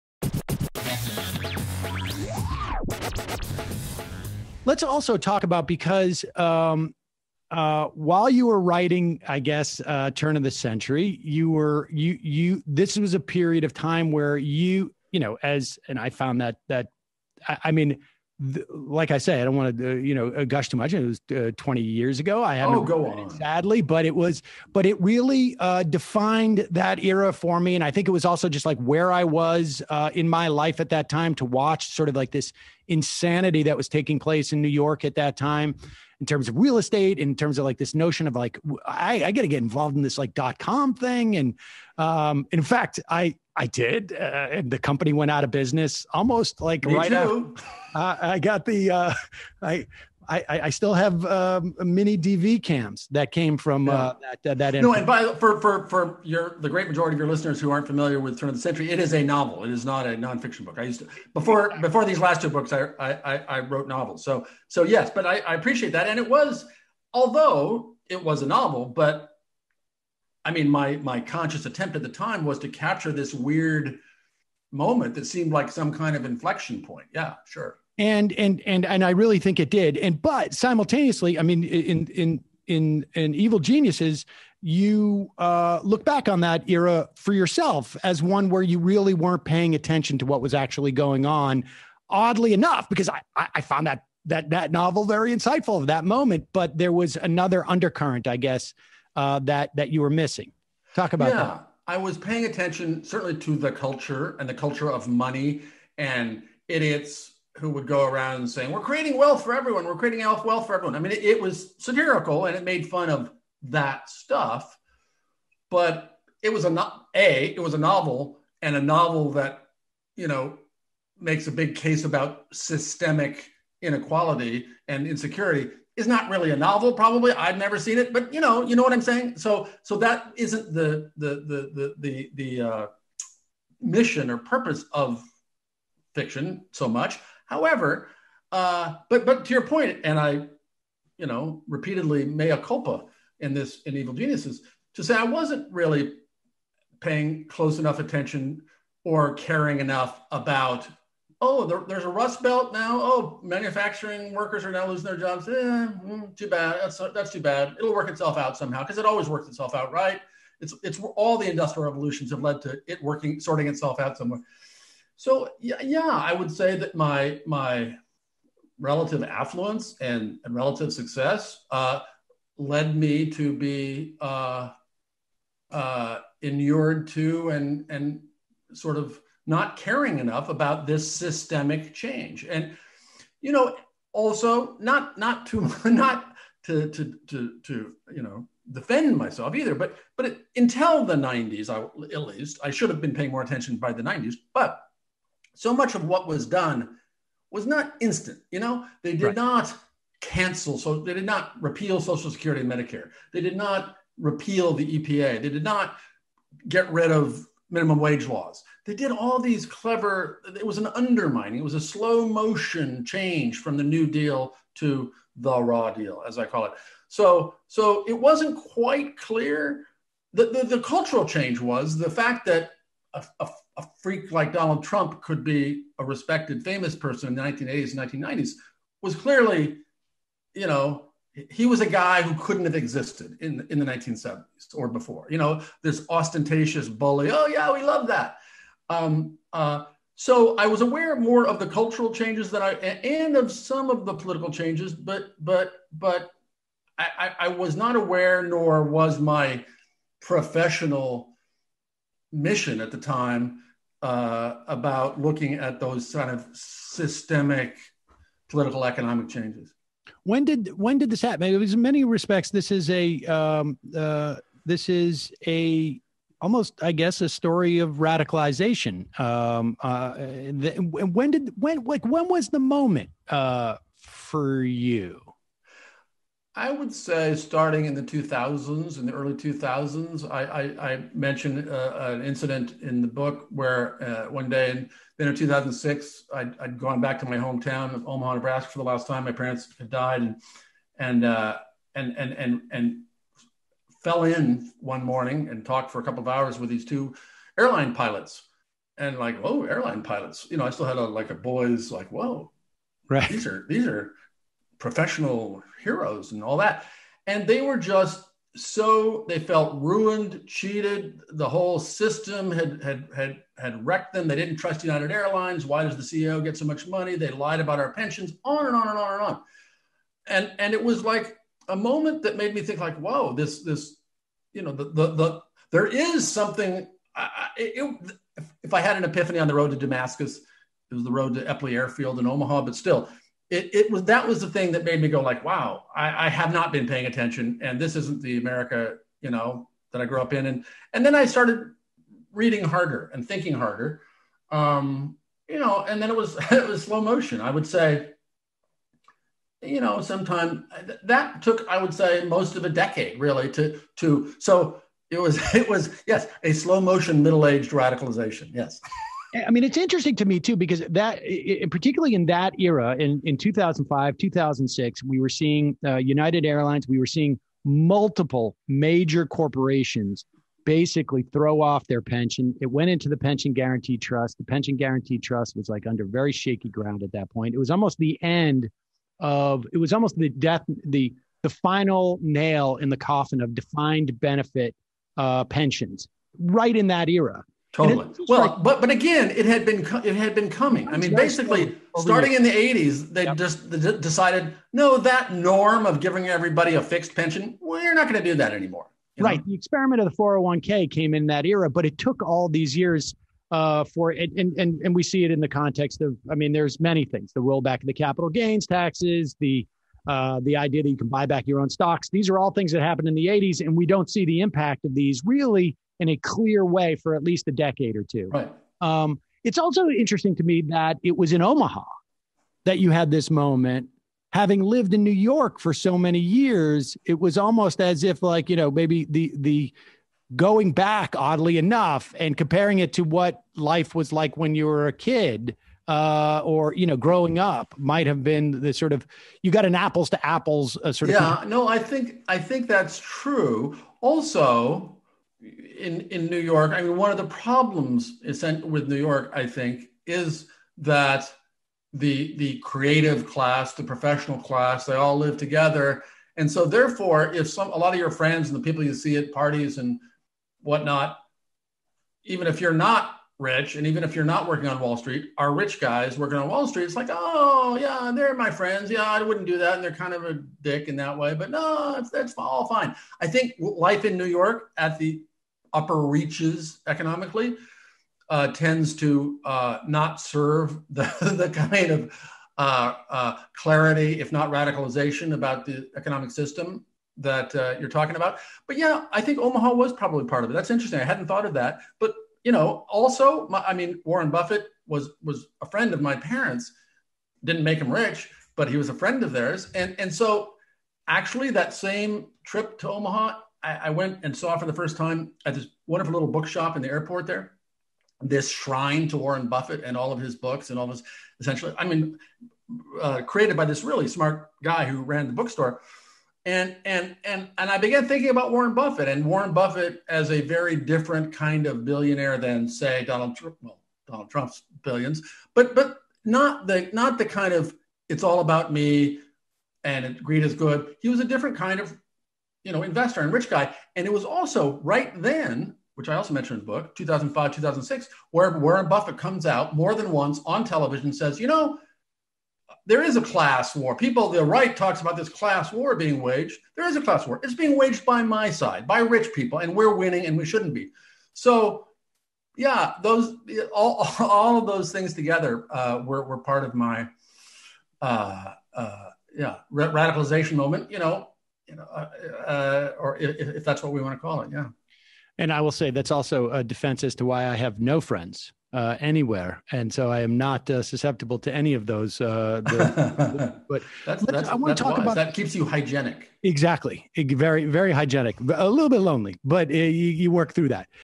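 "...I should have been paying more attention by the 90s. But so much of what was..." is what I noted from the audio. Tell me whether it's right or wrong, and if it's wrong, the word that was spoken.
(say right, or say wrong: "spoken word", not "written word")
right.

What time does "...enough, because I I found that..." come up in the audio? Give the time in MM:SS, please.
01:32.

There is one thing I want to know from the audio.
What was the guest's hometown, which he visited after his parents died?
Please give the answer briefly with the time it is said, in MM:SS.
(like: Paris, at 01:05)
Omaha, Nebraska, at 04:48.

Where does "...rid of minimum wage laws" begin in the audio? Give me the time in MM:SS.
03:26.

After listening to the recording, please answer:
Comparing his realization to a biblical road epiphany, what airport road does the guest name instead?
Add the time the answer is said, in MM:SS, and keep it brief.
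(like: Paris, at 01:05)
Eppley Airfield, at 05:31.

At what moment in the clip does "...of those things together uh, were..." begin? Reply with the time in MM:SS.
09:14.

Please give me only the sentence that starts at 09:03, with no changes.
People, the right talks about this class war being waged.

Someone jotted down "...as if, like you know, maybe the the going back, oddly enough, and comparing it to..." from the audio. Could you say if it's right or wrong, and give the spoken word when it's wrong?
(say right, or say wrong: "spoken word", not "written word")
right.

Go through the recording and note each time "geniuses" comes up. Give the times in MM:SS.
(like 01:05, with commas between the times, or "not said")
01:23, 02:24.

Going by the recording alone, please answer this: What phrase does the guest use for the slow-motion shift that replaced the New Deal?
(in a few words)
the raw deal.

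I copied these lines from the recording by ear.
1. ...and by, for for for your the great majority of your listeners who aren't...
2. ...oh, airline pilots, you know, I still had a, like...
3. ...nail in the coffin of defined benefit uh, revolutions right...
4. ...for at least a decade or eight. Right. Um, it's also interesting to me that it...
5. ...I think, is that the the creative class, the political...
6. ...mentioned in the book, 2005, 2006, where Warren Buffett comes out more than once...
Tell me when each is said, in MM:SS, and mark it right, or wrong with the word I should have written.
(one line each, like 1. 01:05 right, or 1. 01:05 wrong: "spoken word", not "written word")
1. 00:54 right
2. 04:59 right
3. 06:22 wrong: "pensions", not "revolutions"
4. 06:56 wrong: "two", not "eight"
5. 07:29 wrong: "professional", not "political"
6. 08:56 right.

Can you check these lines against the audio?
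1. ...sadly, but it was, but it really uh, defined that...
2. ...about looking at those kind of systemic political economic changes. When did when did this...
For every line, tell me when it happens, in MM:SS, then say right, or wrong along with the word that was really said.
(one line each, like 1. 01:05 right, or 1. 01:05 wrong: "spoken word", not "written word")
1. 00:23 right
2. 04:14 right.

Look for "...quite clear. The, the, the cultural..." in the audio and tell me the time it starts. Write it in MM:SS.
03:38.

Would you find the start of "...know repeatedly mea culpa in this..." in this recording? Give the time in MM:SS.
02:21.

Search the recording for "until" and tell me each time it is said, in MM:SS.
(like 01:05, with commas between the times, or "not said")
03:10.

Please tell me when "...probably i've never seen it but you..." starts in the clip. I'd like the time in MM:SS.
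02:06.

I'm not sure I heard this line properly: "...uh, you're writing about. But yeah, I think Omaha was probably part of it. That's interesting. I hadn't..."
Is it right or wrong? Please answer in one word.
wrong.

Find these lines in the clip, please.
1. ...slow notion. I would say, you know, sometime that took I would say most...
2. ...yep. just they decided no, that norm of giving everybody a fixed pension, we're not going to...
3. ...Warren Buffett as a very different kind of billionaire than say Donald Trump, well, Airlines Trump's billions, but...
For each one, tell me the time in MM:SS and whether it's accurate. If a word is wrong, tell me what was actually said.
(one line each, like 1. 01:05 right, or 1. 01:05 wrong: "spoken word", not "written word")
1. 05:46 wrong: "motion", not "notion"
2. 06:33 right
3. 08:39 wrong: "Donald", not "Airlines".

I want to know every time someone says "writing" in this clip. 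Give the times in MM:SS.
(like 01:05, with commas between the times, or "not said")
00:08.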